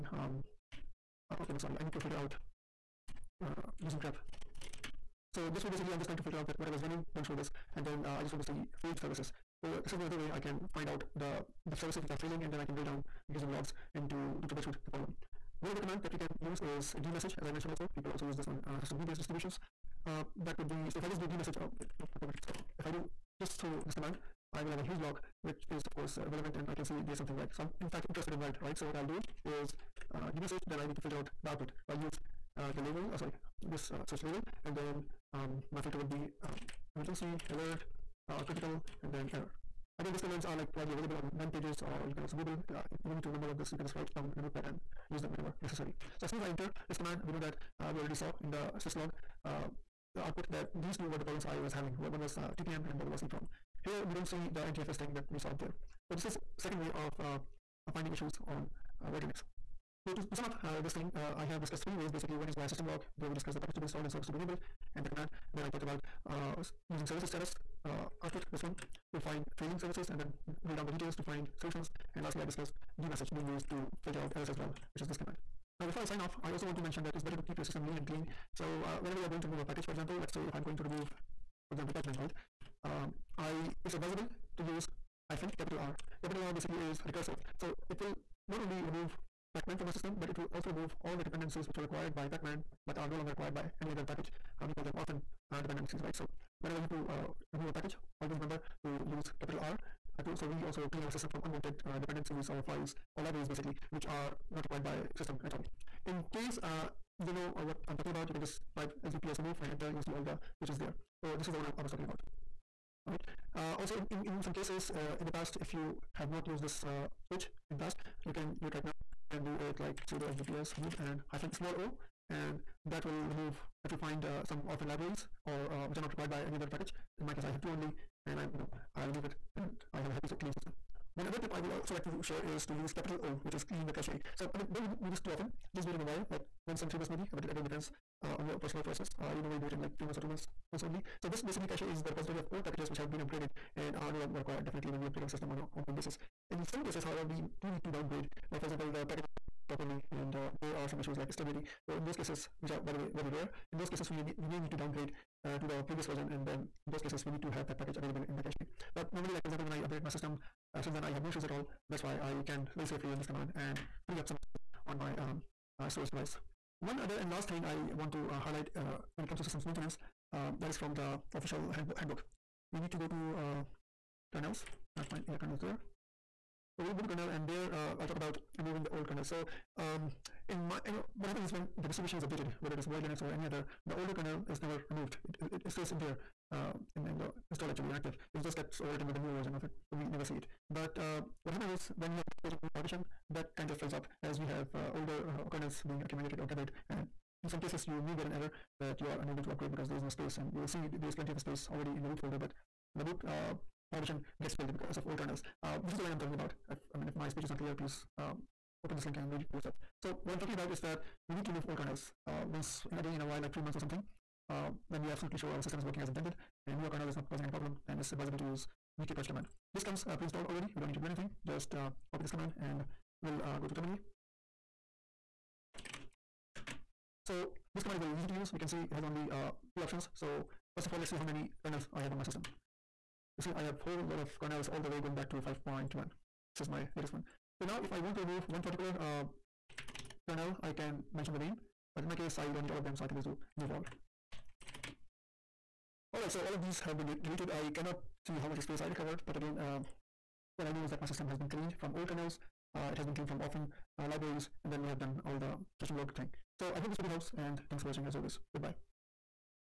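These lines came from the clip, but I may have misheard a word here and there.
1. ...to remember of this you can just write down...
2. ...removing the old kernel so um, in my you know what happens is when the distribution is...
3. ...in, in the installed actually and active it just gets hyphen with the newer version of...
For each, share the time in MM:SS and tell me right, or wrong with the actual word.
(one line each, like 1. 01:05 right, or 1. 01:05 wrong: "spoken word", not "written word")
1. 00:43 right
2. 02:58 right
3. 03:06 wrong: "overwritten", not "hyphen".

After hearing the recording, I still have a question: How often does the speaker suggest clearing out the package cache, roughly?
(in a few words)
once in three months.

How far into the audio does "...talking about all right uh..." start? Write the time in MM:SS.
01:51.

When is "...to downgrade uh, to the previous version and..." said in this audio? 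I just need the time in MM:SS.
02:34.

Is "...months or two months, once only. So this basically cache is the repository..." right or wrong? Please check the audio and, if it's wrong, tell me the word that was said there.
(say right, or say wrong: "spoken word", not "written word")
right.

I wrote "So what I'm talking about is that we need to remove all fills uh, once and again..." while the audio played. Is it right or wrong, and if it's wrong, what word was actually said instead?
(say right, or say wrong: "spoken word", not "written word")
wrong: "kernels", not "fills".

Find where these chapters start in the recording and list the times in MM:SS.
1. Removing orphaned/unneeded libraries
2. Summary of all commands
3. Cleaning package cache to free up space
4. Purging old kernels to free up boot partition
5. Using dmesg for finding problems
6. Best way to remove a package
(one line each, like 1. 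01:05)
1. 01:55
2. 04:09
3. 02:10
4. 02:55
5. 00:15
6. 01:17.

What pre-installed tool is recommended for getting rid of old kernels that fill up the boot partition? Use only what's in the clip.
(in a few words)
vkpurge.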